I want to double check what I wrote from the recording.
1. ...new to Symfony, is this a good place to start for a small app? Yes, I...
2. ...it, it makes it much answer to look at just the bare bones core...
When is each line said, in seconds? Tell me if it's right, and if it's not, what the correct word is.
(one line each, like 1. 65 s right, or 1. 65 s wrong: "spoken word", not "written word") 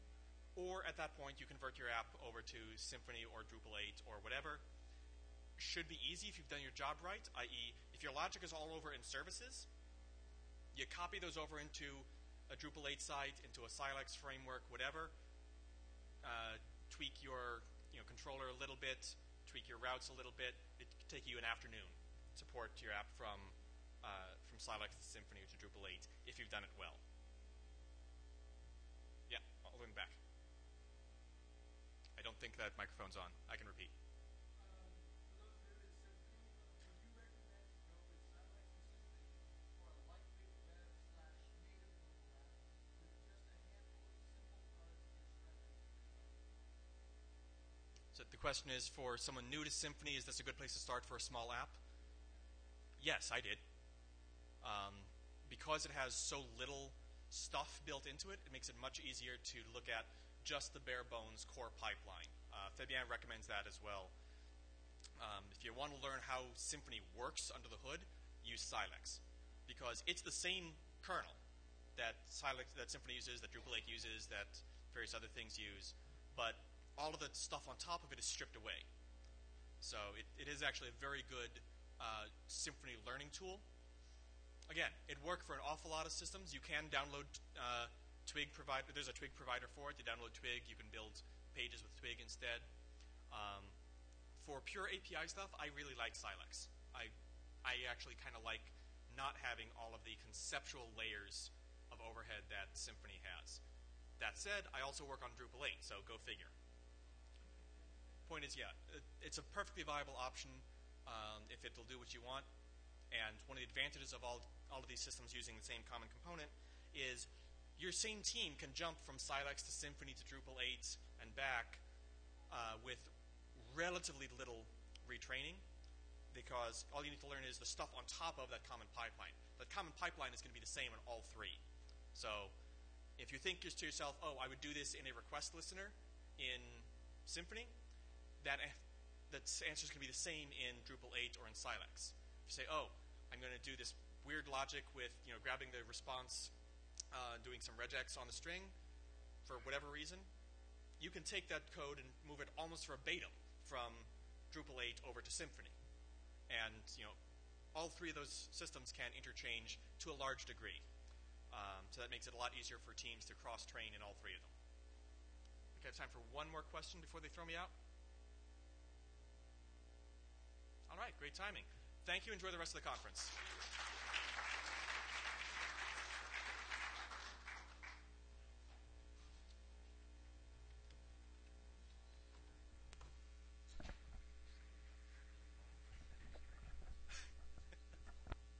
1. 49 s right
2. 58 s wrong: "easier", not "answer".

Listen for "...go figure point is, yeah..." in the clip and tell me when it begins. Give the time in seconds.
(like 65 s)
106 s.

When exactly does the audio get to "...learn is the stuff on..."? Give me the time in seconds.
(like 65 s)
127 s.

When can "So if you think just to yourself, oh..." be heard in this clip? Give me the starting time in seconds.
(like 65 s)
132 s.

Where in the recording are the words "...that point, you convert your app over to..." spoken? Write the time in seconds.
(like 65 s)
0 s.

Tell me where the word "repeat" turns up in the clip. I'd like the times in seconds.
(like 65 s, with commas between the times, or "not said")
33 s.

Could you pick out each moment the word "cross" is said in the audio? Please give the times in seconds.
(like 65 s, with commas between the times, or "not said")
163 s.